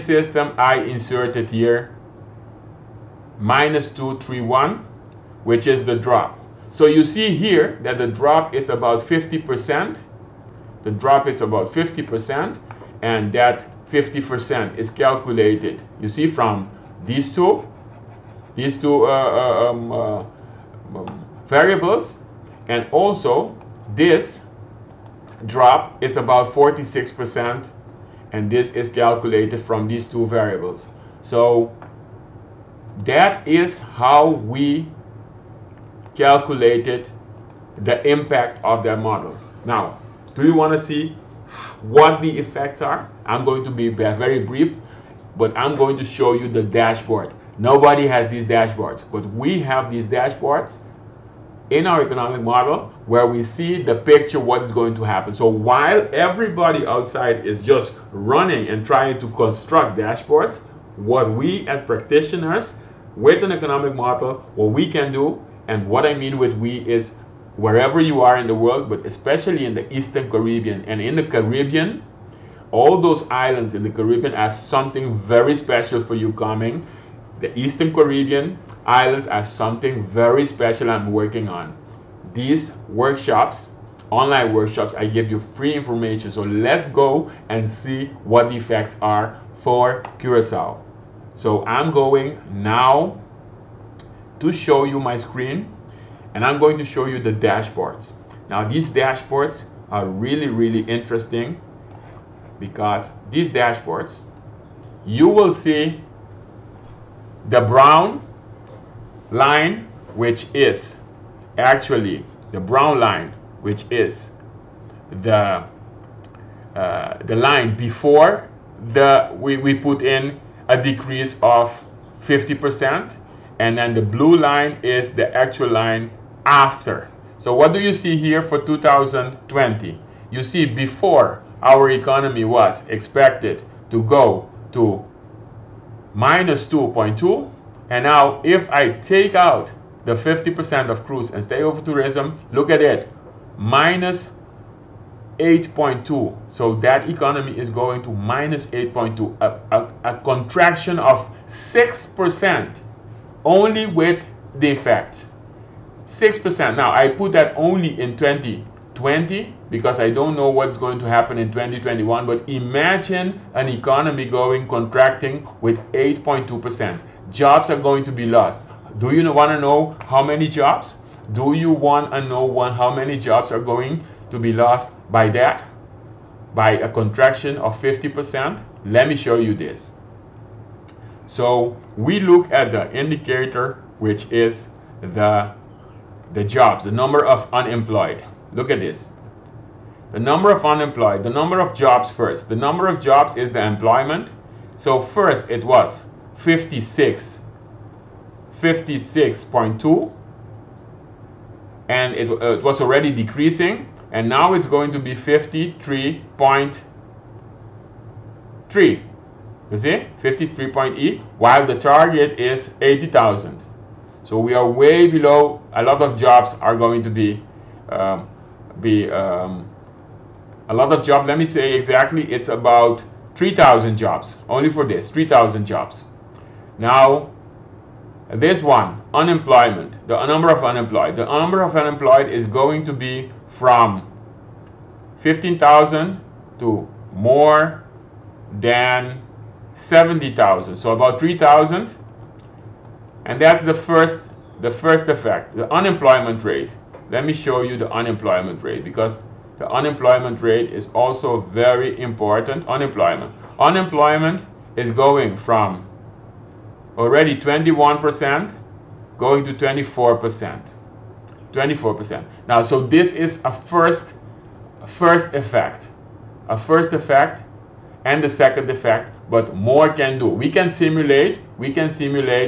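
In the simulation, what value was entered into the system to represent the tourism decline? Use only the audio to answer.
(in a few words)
-231.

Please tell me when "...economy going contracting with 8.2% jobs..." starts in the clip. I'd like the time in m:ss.
2:43.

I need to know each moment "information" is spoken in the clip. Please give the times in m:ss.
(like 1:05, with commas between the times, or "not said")
1:25.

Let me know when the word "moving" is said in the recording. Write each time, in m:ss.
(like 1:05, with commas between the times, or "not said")
not said.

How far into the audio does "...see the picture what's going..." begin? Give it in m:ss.
0:53.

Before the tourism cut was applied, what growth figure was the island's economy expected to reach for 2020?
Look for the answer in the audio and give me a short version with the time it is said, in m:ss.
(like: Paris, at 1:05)
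-2.2, at 2:16.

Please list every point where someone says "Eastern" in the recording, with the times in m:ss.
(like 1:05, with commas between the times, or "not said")
1:09, 1:17.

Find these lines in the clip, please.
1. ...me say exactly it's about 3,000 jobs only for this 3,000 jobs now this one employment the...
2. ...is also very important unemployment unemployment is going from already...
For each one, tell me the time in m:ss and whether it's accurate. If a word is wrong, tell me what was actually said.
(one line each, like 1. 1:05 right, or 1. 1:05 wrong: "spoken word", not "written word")
1. 3:41 wrong: "unemployment", not "employment"
2. 4:10 right.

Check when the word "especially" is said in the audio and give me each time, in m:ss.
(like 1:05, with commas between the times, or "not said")
1:09.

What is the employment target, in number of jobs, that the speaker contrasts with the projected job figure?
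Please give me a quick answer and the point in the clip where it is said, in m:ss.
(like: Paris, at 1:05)
80,000, at 3:32.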